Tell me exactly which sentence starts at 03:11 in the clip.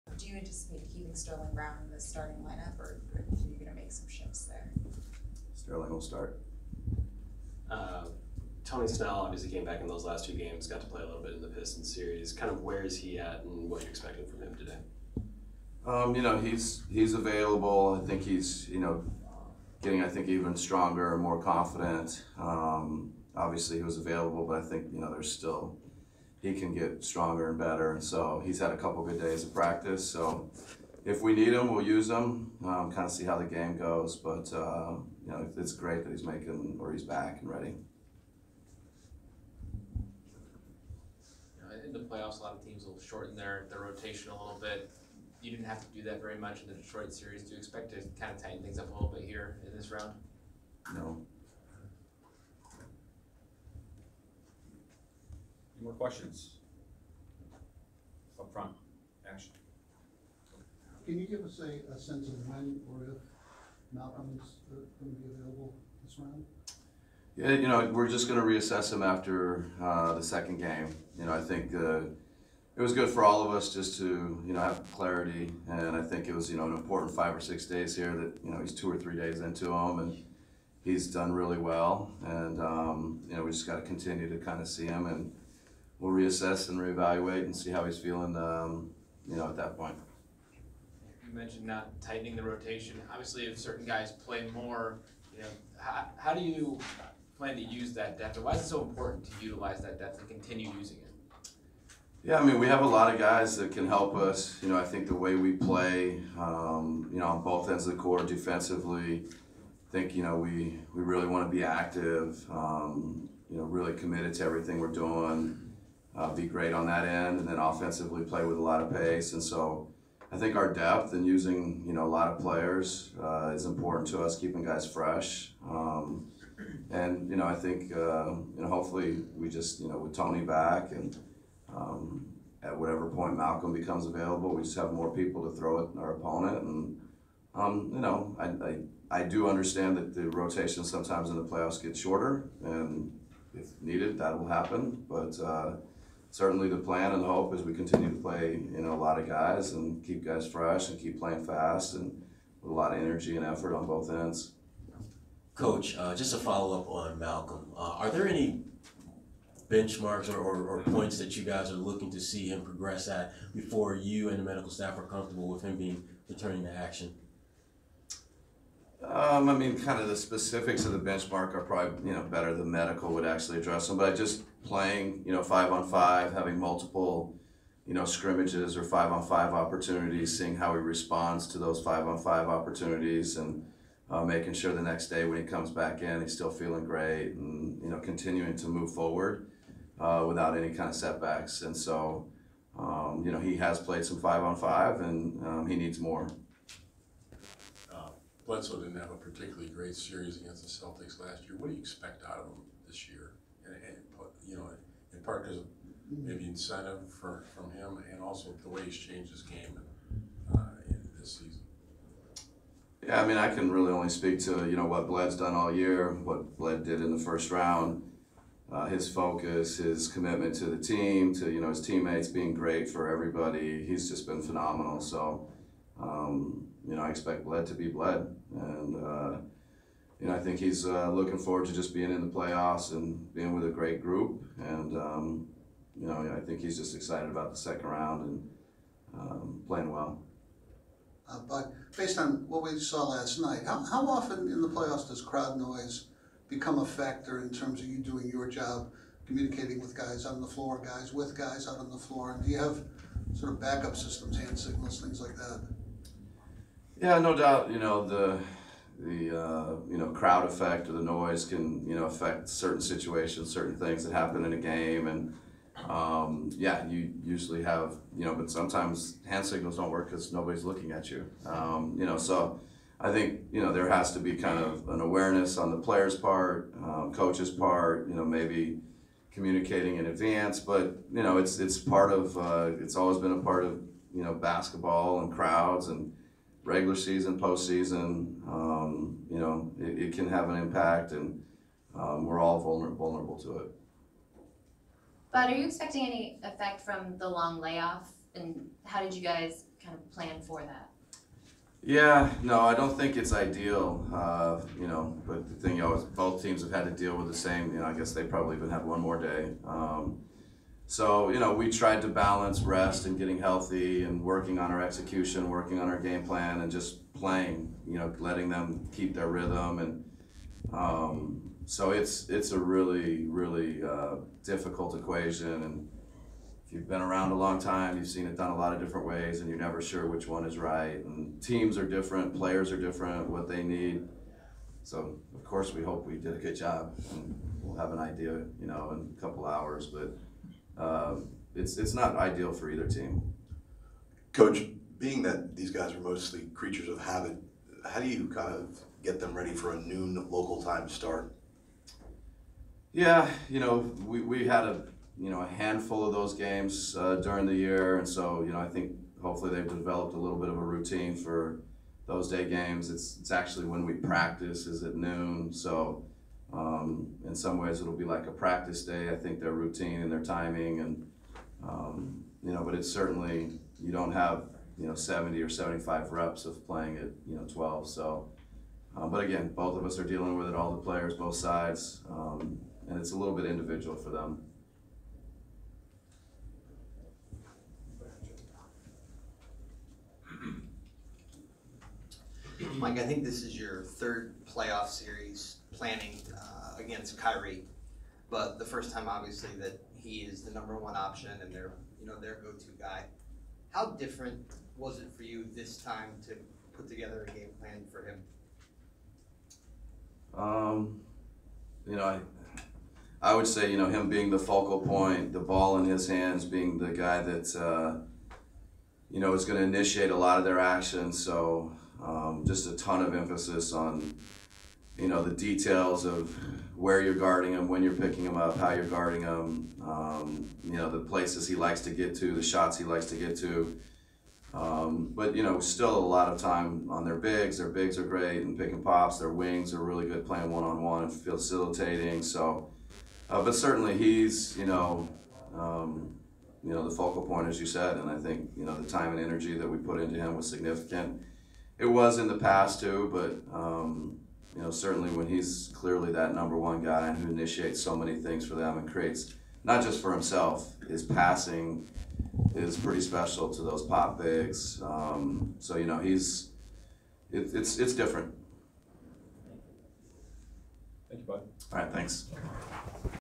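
And so, um, you know, he has played some five on five, and um, he needs more.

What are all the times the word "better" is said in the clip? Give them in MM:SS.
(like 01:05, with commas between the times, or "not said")
00:27, 02:52.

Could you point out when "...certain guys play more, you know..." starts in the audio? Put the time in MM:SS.
01:33.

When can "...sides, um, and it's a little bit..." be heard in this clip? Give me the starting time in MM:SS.
06:21.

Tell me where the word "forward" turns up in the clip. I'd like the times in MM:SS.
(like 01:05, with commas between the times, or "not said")
03:08, 03:51.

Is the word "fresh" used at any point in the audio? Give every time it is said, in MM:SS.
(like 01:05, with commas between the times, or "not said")
02:04, 02:30.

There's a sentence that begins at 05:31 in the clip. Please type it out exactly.
And teams are different, players are different, what they need.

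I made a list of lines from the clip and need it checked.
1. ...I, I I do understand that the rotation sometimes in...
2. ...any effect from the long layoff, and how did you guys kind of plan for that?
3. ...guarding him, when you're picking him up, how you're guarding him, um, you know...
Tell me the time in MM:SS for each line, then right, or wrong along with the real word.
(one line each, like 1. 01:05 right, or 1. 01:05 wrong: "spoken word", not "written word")
1. 02:18 right
2. 04:56 right
3. 07:07 right.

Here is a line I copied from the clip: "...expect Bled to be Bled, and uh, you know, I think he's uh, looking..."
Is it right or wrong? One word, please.
right.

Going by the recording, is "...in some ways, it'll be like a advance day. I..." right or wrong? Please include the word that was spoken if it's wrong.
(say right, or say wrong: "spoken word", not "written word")
wrong: "practice", not "advance".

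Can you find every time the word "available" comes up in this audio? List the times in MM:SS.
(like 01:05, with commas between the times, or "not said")
00:17, 00:23, 01:05, 02:14.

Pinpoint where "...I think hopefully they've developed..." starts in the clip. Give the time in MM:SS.
05:58.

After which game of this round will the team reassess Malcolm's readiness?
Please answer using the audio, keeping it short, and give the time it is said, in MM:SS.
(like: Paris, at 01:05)
The second game, at 01:10.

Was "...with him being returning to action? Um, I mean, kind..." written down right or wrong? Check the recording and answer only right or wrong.
right.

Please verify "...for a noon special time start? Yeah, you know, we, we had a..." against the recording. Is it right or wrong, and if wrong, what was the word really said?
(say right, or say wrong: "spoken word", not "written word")
wrong: "local", not "special".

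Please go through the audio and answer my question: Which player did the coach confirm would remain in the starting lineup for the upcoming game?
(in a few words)
Sterling Brown.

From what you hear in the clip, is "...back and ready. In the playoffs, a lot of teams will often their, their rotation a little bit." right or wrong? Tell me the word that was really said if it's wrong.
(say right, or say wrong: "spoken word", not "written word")
wrong: "shorten", not "often".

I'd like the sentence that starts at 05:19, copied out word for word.
And um, so it's, it's a really, really uh, difficult equation.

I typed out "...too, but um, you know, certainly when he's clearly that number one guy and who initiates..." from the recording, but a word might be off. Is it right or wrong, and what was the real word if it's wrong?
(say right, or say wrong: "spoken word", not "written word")
right.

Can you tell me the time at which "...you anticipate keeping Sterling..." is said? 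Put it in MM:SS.
00:00.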